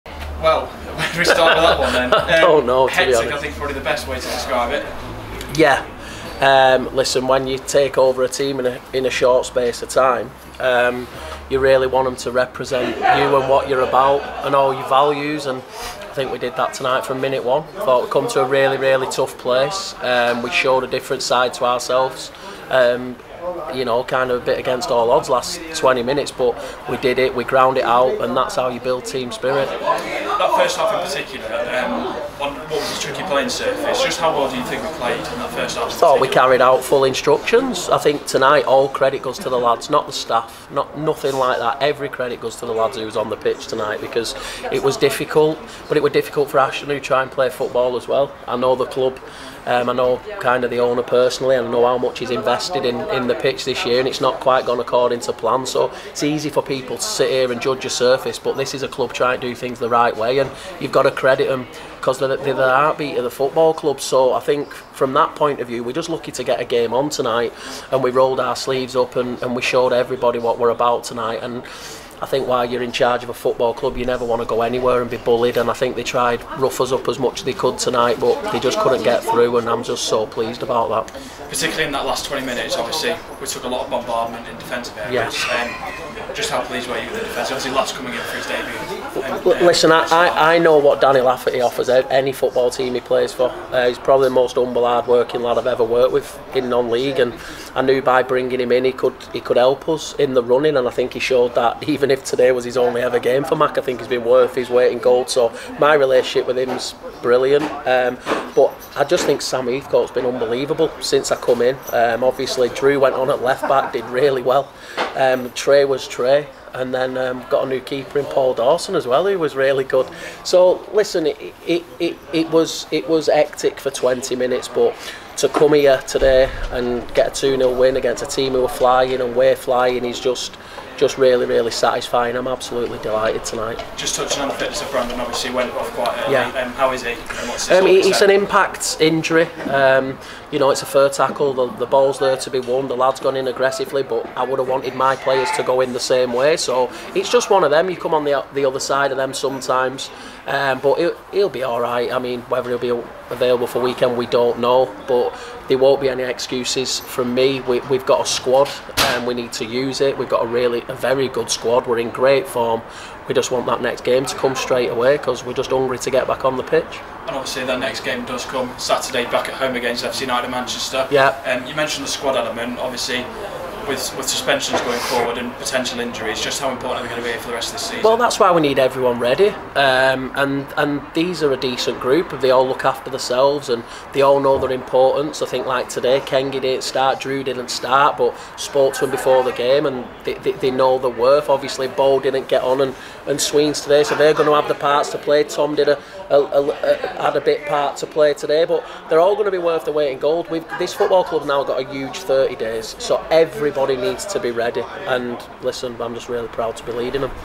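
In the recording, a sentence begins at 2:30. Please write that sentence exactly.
Um, but he'll, he'll be all right.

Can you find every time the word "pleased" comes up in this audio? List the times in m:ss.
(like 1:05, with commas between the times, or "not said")
1:20, 1:26.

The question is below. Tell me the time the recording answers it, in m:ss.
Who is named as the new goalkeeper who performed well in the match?
1:58.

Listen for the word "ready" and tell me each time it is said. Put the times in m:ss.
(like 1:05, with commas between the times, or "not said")
2:59, 3:24.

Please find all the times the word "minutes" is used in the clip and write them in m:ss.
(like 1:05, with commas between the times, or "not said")
0:17, 0:26, 1:22, 2:04.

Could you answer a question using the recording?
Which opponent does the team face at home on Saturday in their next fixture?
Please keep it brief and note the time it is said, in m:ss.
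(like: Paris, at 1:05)
FC United Manchester, at 2:50.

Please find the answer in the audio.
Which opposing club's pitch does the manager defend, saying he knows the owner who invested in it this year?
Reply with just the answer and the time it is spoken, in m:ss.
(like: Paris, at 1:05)
Ashton, at 0:46.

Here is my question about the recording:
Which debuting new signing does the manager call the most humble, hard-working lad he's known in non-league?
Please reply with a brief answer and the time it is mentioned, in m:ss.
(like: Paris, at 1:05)
Danny Lafferty, at 1:31.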